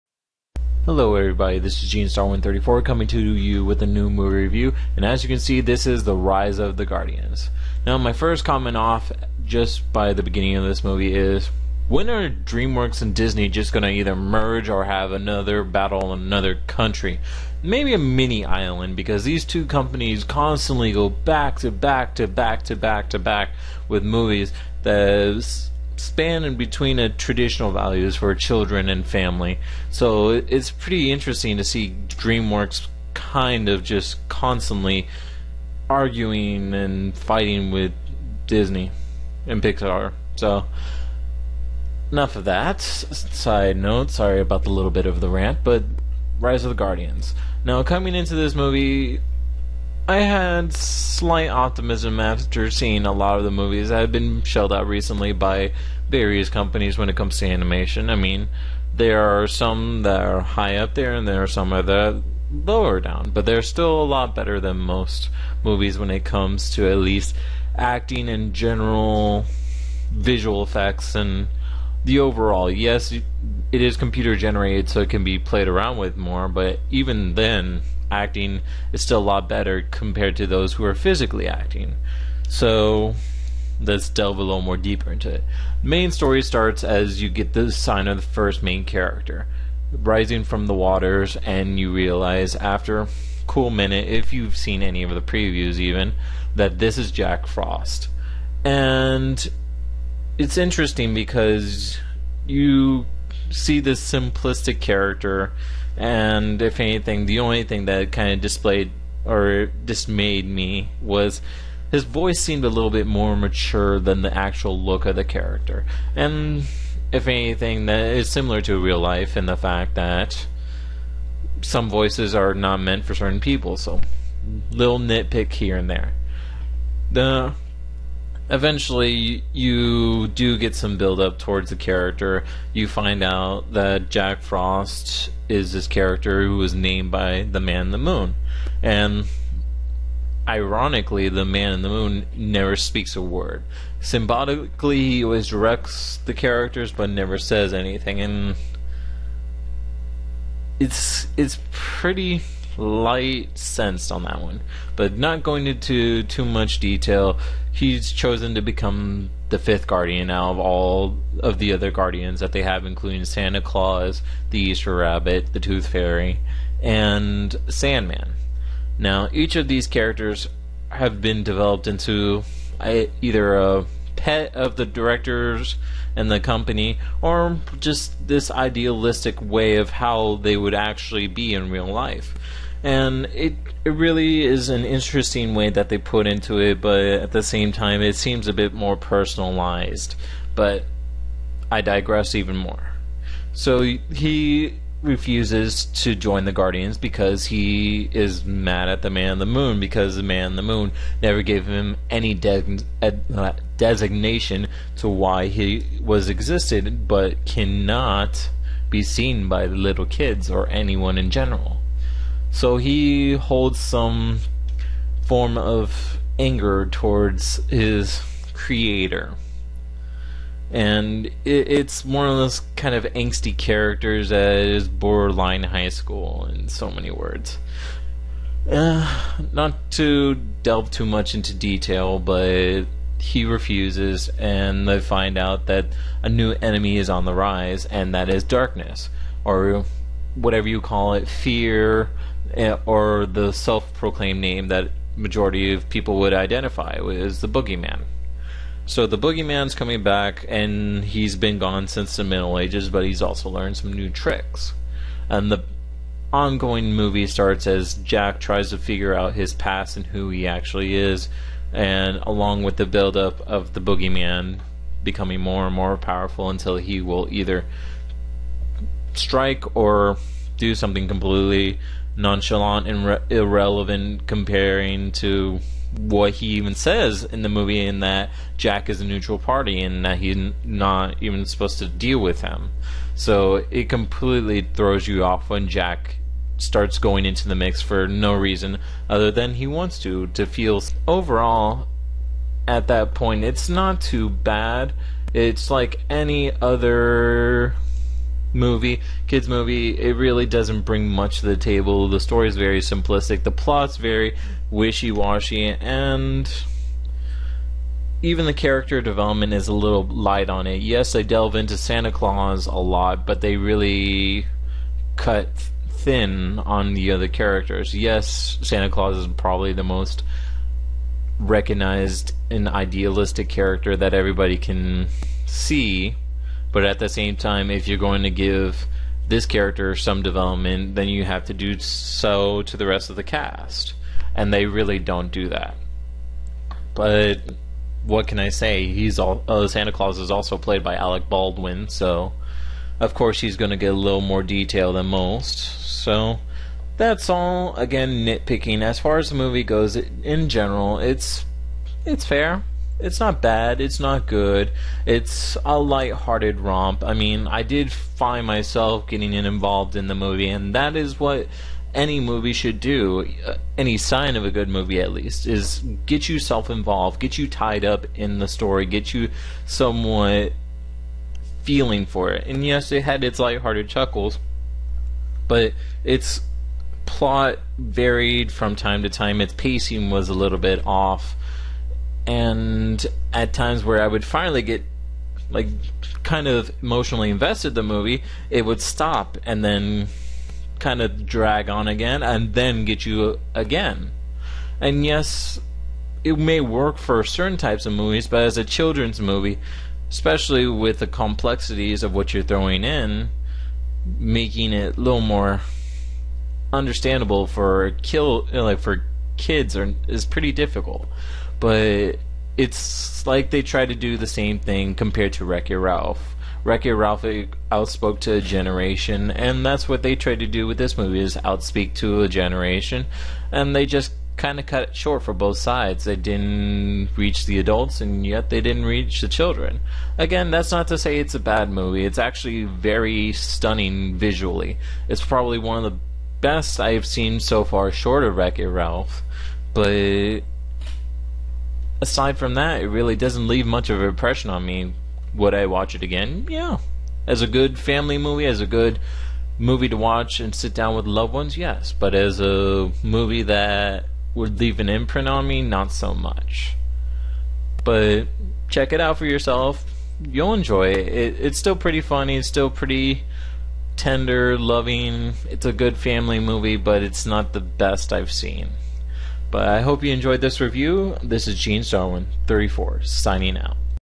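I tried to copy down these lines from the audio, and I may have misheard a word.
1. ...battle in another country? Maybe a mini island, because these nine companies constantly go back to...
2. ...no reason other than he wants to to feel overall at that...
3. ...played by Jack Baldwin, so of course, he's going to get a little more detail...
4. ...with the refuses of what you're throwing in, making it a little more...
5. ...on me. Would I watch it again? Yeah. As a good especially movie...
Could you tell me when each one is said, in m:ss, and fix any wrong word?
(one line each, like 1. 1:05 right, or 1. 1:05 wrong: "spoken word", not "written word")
1. 0:15 wrong: "two", not "nine"
2. 4:48 right
3. 5:40 wrong: "Alec", not "Jack"
4. 6:40 wrong: "complexities", not "refuses"
5. 7:24 wrong: "family", not "especially".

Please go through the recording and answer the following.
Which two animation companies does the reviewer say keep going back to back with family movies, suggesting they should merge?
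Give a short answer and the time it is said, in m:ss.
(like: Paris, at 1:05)
DreamWorks and Disney, at 0:12.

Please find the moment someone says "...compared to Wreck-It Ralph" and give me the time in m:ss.
6:54.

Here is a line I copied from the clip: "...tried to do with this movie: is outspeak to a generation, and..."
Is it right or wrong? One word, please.
right.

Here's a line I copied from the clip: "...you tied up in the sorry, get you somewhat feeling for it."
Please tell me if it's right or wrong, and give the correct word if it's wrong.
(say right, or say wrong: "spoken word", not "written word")
wrong: "story", not "sorry".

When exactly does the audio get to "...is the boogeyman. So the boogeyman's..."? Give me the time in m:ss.
4:07.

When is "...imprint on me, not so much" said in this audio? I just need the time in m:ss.
7:34.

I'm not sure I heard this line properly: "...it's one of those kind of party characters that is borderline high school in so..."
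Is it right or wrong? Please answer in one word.
wrong.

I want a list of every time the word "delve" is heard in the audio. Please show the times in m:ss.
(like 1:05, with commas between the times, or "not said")
1:24, 3:50, 5:11.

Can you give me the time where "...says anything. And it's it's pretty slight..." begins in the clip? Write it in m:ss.
2:27.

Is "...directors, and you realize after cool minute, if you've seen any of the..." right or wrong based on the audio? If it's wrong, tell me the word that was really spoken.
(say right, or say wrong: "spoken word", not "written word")
wrong: "waters", not "directors".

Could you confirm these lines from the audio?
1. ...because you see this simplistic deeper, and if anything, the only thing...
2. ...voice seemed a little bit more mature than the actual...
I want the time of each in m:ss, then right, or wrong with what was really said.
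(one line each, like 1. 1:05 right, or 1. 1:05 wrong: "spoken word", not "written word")
1. 1:41 wrong: "character", not "deeper"
2. 1:52 right.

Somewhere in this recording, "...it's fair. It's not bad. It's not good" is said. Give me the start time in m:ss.
5:52.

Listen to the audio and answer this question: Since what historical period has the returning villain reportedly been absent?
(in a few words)
the Middle Ages.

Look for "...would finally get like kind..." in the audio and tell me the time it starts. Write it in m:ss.
6:24.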